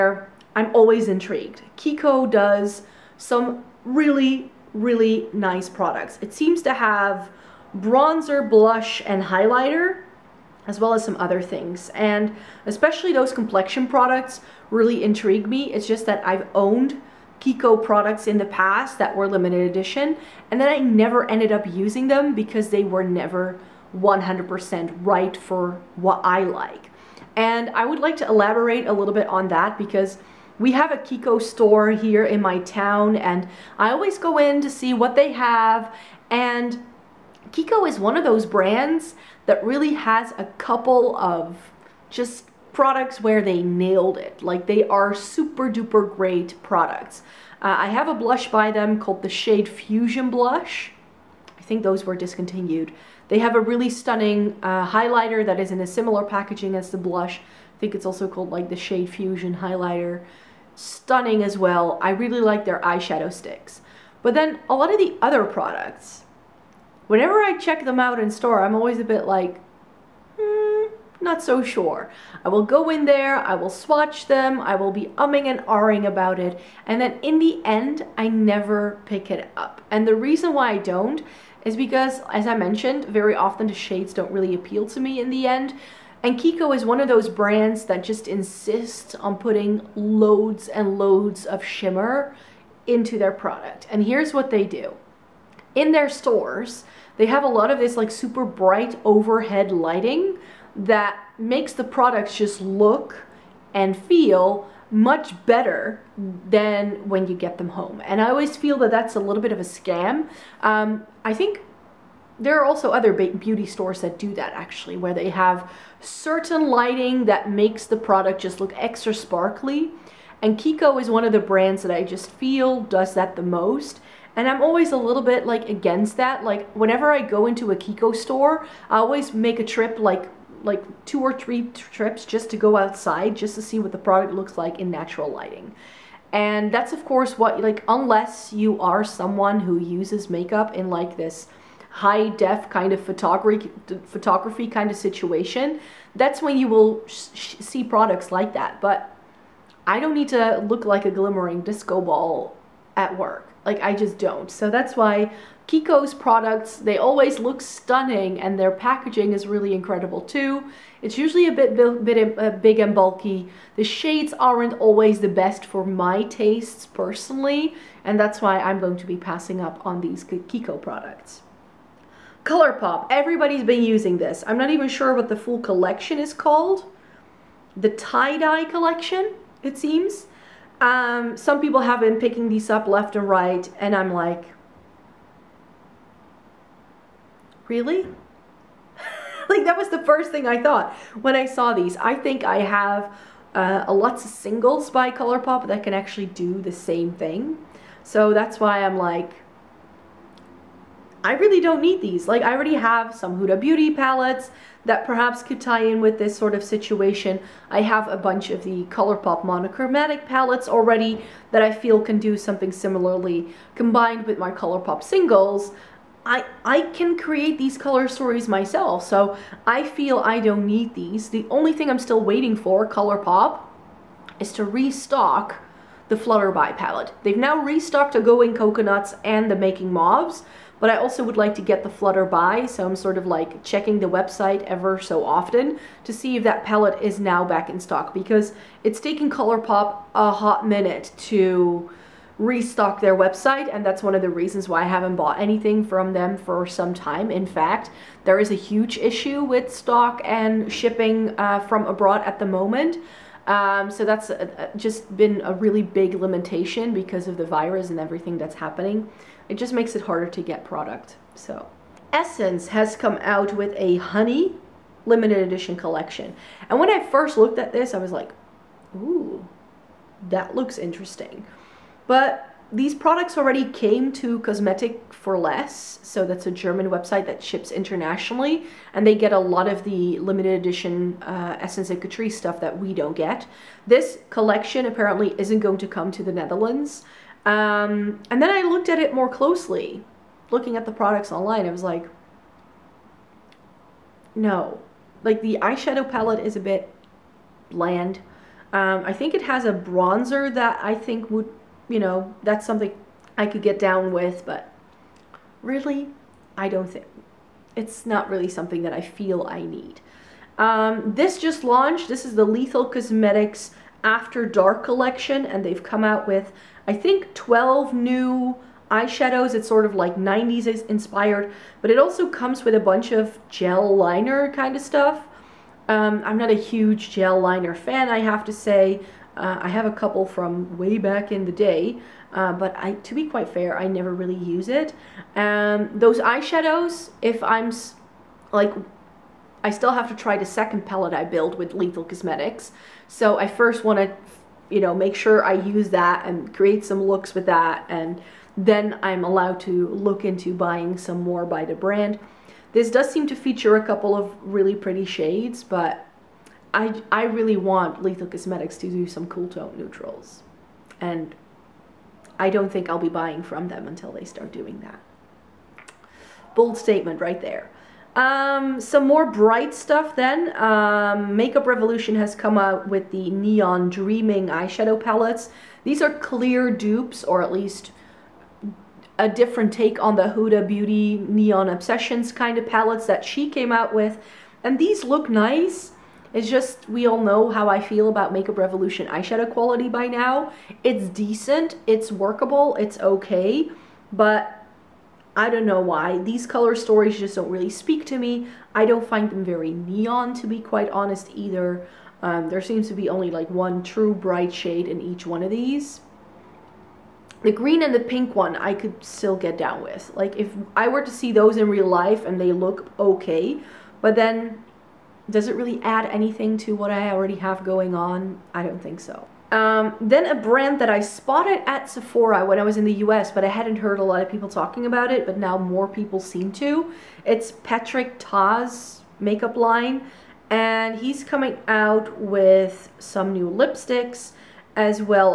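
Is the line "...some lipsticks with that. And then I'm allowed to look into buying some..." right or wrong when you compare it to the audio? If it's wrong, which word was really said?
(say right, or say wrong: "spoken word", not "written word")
wrong: "looks", not "lipsticks".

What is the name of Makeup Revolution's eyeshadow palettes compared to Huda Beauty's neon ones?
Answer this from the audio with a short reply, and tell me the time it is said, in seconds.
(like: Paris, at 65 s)
Neon Dreaming, at 373 s.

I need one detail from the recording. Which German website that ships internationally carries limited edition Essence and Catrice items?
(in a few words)
Cosmetic for Less.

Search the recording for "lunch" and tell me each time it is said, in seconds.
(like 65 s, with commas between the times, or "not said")
not said.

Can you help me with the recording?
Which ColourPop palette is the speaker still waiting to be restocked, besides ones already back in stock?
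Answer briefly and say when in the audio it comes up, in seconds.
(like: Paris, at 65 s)
Flutterby, at 226 s.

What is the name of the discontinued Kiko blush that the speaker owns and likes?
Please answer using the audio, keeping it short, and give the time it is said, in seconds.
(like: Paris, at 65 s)
Shade Fusion Blush, at 49 s.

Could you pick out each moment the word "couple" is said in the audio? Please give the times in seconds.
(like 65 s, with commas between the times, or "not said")
40 s, 329 s, 353 s.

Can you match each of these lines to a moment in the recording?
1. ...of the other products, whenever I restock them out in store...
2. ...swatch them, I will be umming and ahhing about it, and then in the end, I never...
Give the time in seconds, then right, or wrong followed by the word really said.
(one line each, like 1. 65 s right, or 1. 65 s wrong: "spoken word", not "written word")
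1. 64 s wrong: "check", not "restock"
2. 73 s right.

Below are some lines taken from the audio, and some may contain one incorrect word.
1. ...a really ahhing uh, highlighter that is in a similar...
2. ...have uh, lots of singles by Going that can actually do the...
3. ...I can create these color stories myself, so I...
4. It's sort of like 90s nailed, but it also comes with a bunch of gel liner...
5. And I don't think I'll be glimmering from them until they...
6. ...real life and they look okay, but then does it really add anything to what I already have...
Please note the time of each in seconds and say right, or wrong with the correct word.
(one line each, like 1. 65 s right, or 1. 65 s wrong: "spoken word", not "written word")
1. 53 s wrong: "stunning", not "ahhing"
2. 192 s wrong: "ColourPop", not "Going"
3. 216 s right
4. 319 s wrong: "inspired", not "nailed"
5. 360 s wrong: "buying", not "glimmering"
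6. 411 s right.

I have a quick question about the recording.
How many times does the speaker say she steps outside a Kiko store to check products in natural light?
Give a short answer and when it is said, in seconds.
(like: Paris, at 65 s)
2 or 3, at 131 s.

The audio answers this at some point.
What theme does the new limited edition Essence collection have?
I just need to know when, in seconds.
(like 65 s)
263 s.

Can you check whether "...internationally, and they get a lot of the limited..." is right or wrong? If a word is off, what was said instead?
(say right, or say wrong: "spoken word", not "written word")
right.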